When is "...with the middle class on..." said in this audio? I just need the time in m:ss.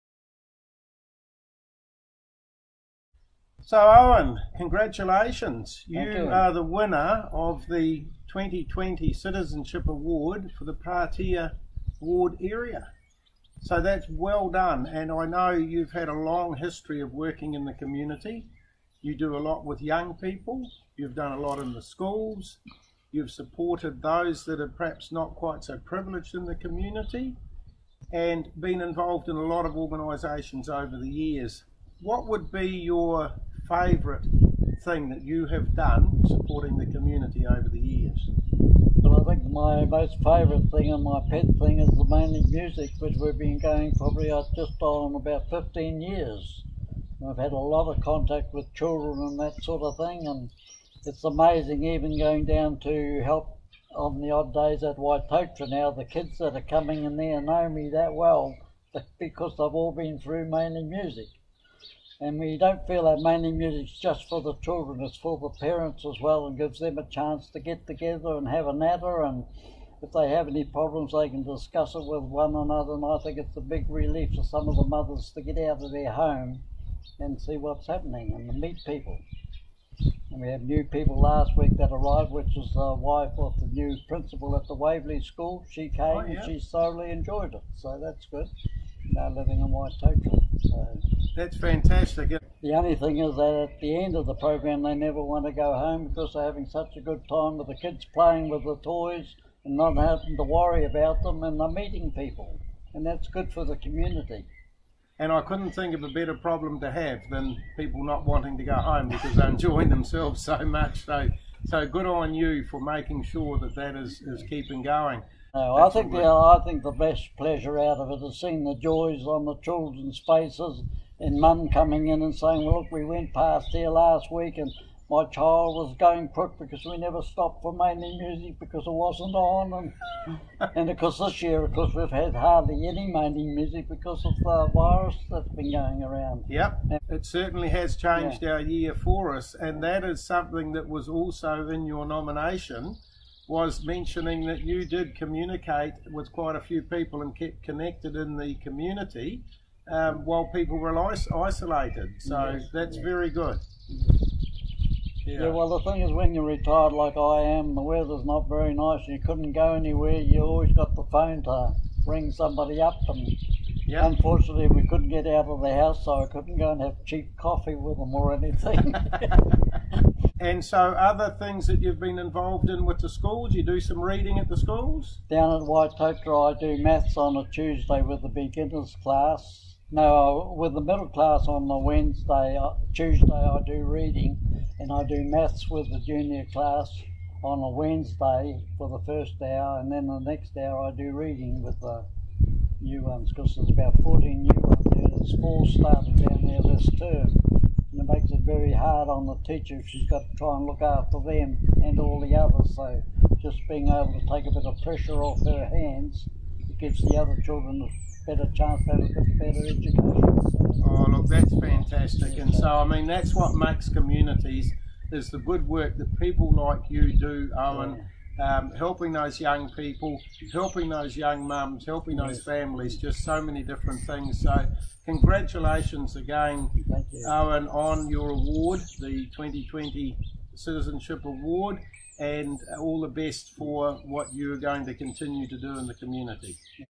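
3:00.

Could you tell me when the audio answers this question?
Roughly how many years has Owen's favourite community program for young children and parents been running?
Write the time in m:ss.
0:45.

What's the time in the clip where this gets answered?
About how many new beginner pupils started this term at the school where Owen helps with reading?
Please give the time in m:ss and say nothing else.
3:14.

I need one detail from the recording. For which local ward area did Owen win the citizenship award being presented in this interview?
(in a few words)
Patea Ward.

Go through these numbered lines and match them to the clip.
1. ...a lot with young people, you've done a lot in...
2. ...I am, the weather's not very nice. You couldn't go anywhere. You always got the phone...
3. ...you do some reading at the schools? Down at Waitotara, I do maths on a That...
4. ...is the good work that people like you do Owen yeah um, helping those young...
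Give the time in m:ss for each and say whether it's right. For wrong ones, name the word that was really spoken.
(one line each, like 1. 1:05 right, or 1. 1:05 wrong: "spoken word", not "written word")
1. 0:19 right
2. 2:37 right
3. 2:53 wrong: "Tuesday", not "That"
4. 3:35 right.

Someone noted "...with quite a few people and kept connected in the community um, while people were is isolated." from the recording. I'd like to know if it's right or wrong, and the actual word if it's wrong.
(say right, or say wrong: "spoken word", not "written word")
right.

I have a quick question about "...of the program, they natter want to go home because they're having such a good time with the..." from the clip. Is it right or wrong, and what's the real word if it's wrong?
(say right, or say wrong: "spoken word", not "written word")
wrong: "never", not "natter".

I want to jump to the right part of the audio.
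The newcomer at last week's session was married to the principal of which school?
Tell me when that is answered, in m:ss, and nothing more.
1:24.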